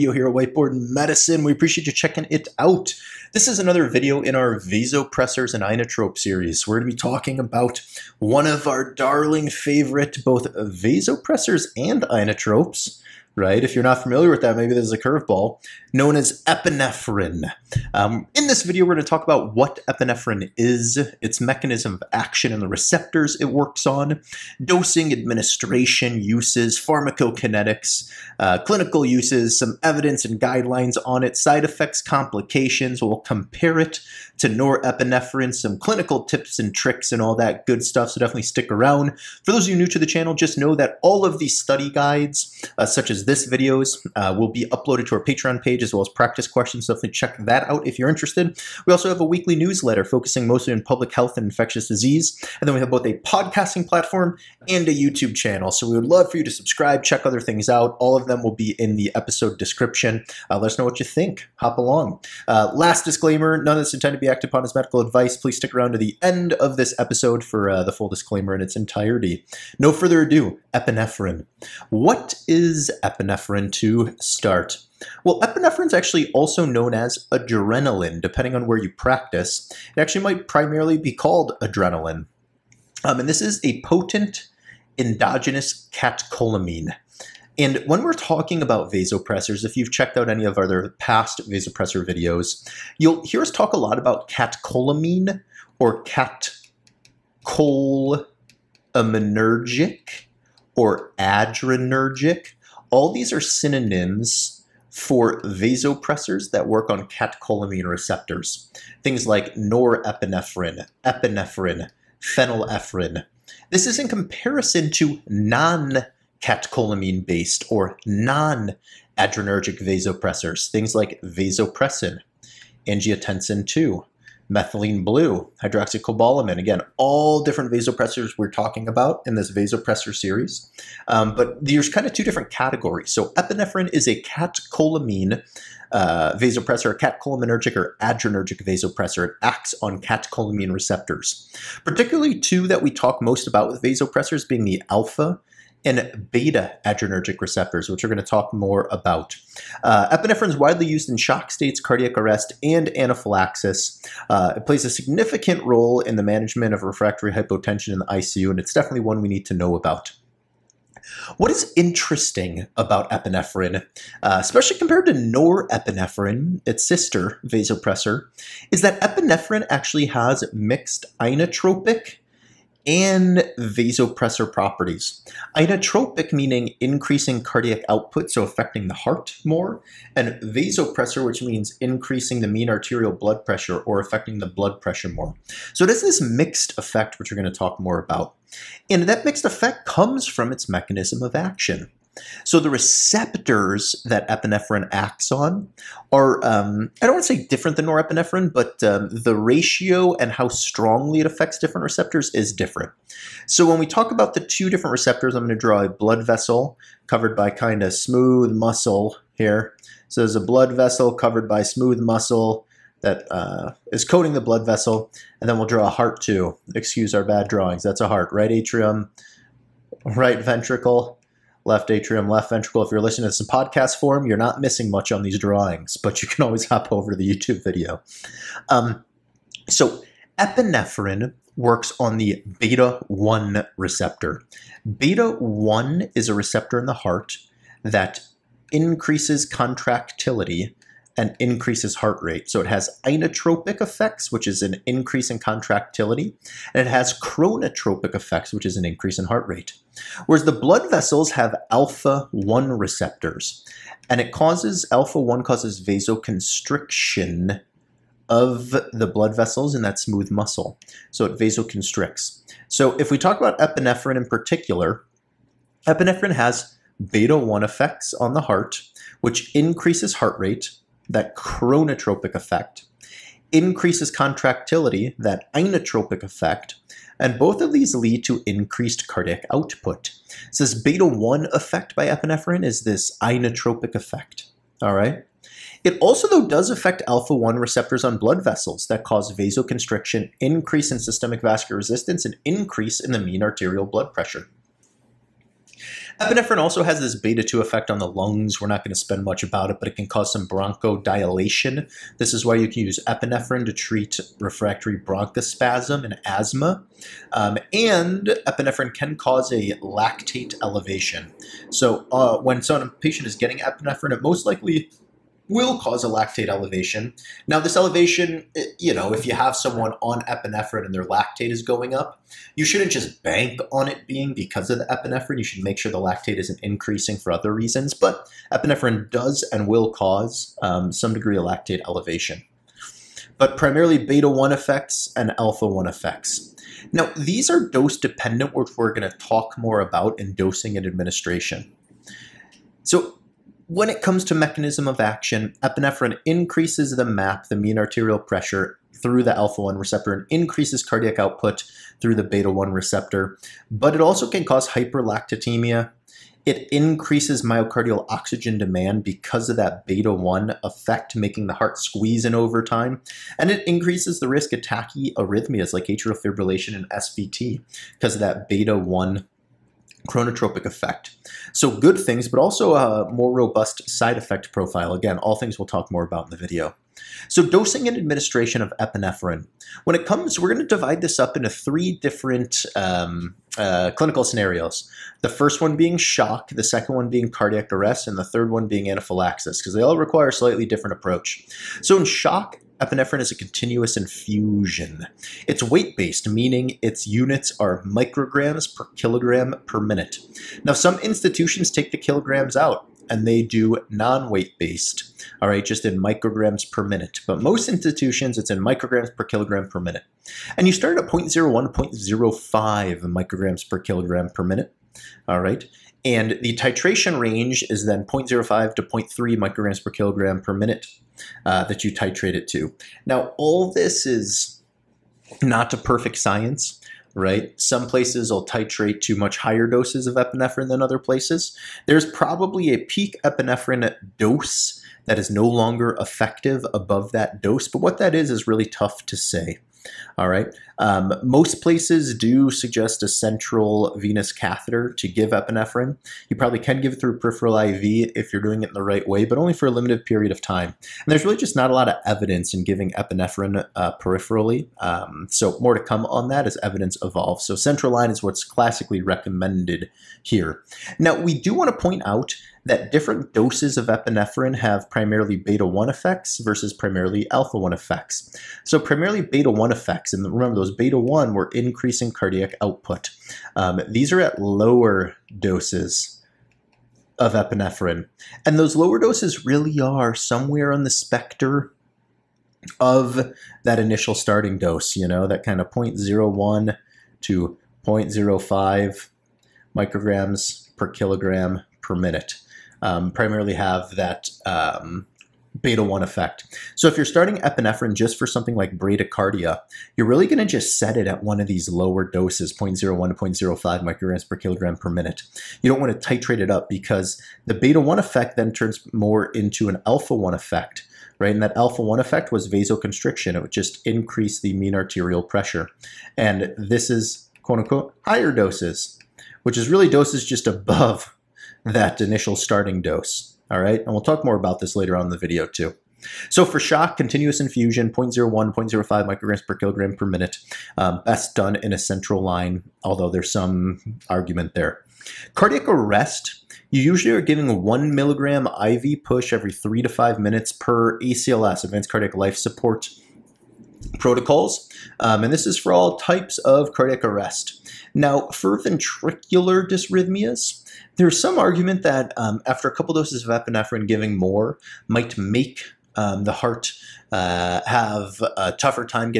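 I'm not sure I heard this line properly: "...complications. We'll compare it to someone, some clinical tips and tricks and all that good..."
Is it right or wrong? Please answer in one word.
wrong.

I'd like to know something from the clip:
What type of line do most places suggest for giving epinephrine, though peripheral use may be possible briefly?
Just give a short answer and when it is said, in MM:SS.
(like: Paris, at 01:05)
Central venous catheter, at 07:23.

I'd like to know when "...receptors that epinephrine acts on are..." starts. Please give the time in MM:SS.
03:12.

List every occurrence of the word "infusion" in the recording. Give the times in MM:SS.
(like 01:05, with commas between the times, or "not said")
06:33, 08:47.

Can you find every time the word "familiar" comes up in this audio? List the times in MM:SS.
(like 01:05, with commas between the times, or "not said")
00:14.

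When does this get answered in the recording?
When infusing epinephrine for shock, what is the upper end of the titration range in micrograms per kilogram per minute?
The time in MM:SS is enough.
06:58.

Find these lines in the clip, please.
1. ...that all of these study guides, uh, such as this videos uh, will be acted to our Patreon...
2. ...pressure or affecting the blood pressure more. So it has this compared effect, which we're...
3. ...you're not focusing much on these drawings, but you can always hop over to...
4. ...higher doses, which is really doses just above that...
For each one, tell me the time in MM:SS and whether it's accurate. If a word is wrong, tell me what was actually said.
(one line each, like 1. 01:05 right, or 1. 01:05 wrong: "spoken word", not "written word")
1. 00:40 wrong: "uploaded", not "acted"
2. 03:03 wrong: "mixed", not "compared"
3. 03:44 wrong: "missing", not "focusing"
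4. 08:38 right.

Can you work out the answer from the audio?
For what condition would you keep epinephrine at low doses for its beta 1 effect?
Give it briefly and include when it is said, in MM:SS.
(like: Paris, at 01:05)
Bradycardia, at 08:18.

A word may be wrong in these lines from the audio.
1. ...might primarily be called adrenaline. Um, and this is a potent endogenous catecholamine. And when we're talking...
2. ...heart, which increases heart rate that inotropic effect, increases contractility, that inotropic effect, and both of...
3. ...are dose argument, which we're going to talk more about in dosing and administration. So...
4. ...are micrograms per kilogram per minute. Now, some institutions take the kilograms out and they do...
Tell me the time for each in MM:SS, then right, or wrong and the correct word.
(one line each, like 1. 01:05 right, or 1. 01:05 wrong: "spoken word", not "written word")
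1. 01:20 right
2. 04:28 wrong: "chronotropic", not "inotropic"
3. 05:37 wrong: "dependent", not "argument"
4. 06:37 right.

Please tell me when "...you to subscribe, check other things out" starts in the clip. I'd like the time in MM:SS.
00:56.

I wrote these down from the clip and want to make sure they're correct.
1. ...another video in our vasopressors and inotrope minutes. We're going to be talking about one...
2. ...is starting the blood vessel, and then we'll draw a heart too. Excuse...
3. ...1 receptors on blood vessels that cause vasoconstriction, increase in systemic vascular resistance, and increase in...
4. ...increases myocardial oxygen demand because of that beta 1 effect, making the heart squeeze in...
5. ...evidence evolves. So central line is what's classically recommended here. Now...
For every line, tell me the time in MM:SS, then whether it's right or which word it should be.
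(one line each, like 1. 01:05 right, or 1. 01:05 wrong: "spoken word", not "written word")
1. 00:03 wrong: "series", not "minutes"
2. 03:33 wrong: "coating", not "starting"
3. 04:47 right
4. 05:56 right
5. 07:36 right.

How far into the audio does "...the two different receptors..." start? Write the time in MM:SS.
03:24.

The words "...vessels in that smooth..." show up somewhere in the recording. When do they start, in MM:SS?
04:19.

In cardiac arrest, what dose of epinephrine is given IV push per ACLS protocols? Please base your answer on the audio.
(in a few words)
1 milligram.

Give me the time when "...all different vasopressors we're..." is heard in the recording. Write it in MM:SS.
02:06.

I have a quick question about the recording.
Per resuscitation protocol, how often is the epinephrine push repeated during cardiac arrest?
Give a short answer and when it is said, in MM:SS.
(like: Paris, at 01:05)
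Every 3 to 5 minutes, at 08:59.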